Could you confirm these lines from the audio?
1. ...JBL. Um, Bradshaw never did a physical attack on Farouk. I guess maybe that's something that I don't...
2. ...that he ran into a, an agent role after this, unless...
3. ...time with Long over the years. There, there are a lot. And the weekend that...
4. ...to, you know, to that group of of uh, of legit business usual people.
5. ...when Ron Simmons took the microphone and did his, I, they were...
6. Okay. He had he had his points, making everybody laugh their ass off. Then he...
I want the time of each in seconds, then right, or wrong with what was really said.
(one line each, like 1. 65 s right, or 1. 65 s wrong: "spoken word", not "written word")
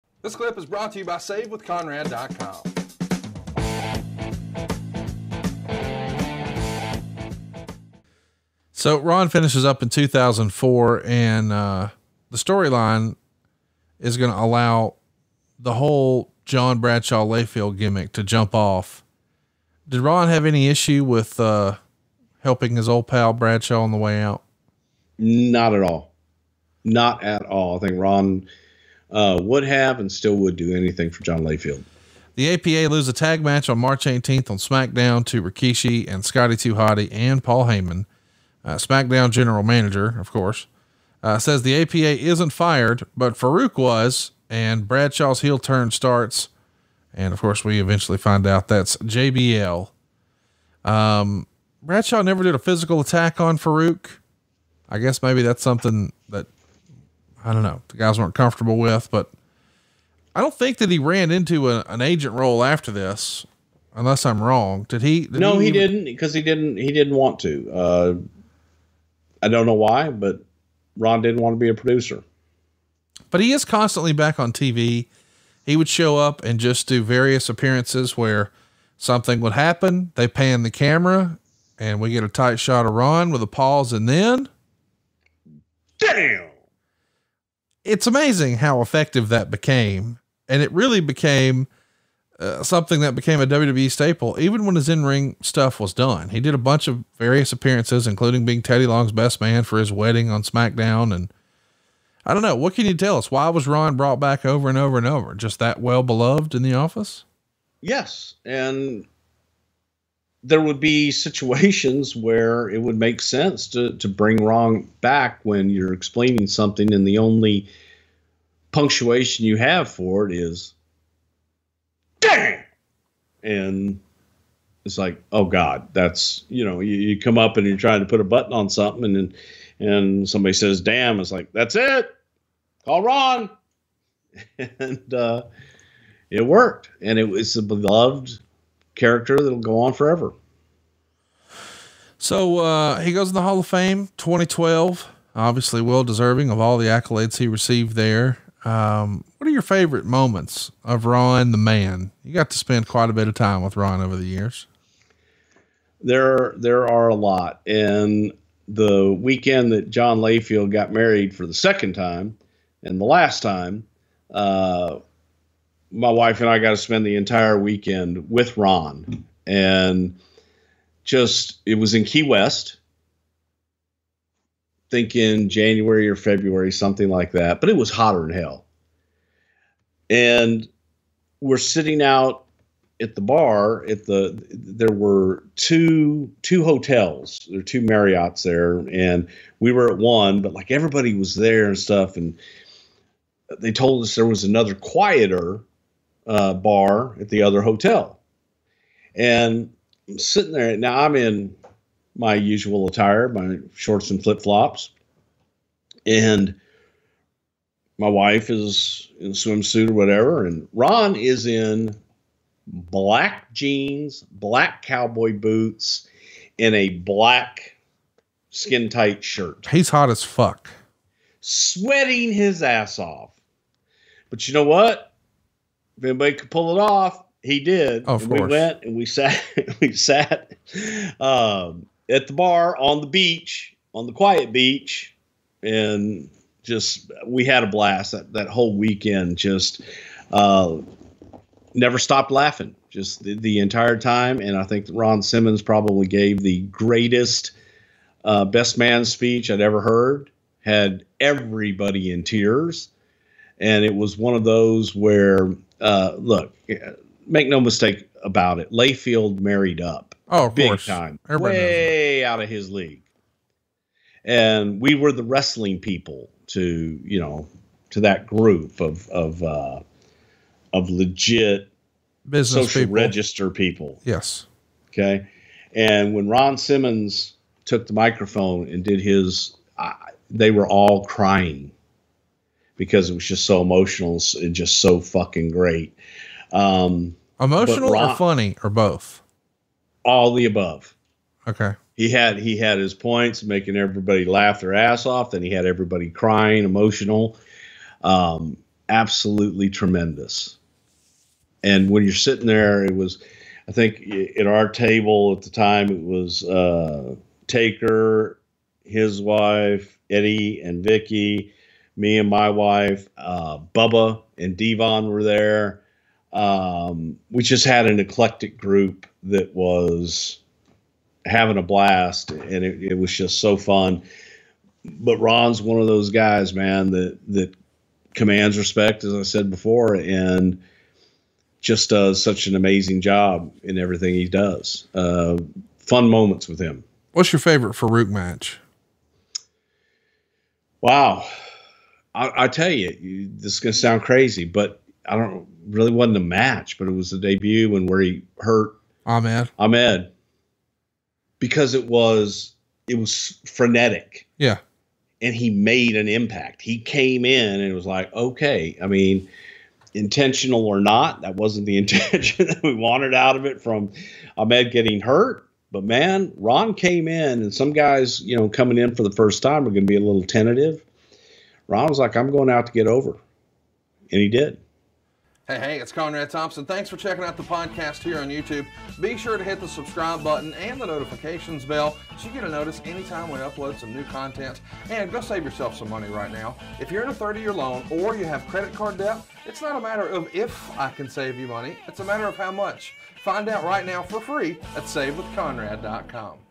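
1. 48 s right
2. 60 s right
3. 153 s wrong: "Ron", not "Long"
4. 266 s wrong: "social", not "usual"
5. 276 s right
6. 291 s right.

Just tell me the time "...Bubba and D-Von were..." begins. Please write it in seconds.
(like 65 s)
313 s.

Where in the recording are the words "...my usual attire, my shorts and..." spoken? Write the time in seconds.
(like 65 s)
202 s.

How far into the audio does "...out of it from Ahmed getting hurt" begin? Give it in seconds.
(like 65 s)
363 s.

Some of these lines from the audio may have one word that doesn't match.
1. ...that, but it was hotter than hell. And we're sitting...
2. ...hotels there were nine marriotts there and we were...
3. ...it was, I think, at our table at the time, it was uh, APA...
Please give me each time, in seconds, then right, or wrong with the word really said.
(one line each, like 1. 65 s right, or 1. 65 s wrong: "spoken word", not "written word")
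1. 177 s right
2. 186 s wrong: "two", not "nine"
3. 302 s wrong: "Taker", not "APA".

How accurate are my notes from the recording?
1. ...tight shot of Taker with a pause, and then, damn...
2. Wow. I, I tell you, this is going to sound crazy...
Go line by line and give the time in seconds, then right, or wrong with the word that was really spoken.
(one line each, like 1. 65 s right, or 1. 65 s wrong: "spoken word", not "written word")
1. 82 s wrong: "Ron", not "Taker"
2. 340 s right.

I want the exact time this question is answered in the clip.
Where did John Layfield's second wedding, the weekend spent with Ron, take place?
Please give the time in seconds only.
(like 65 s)
172 s.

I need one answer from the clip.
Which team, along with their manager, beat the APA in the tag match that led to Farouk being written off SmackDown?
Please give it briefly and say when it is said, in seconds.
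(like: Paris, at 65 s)
Rikishi and Scotty Too Hottie, at 35 s.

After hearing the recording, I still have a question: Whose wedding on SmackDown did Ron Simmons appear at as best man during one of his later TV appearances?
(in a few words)
Teddy Long.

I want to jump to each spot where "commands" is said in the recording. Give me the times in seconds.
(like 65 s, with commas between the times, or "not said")
328 s.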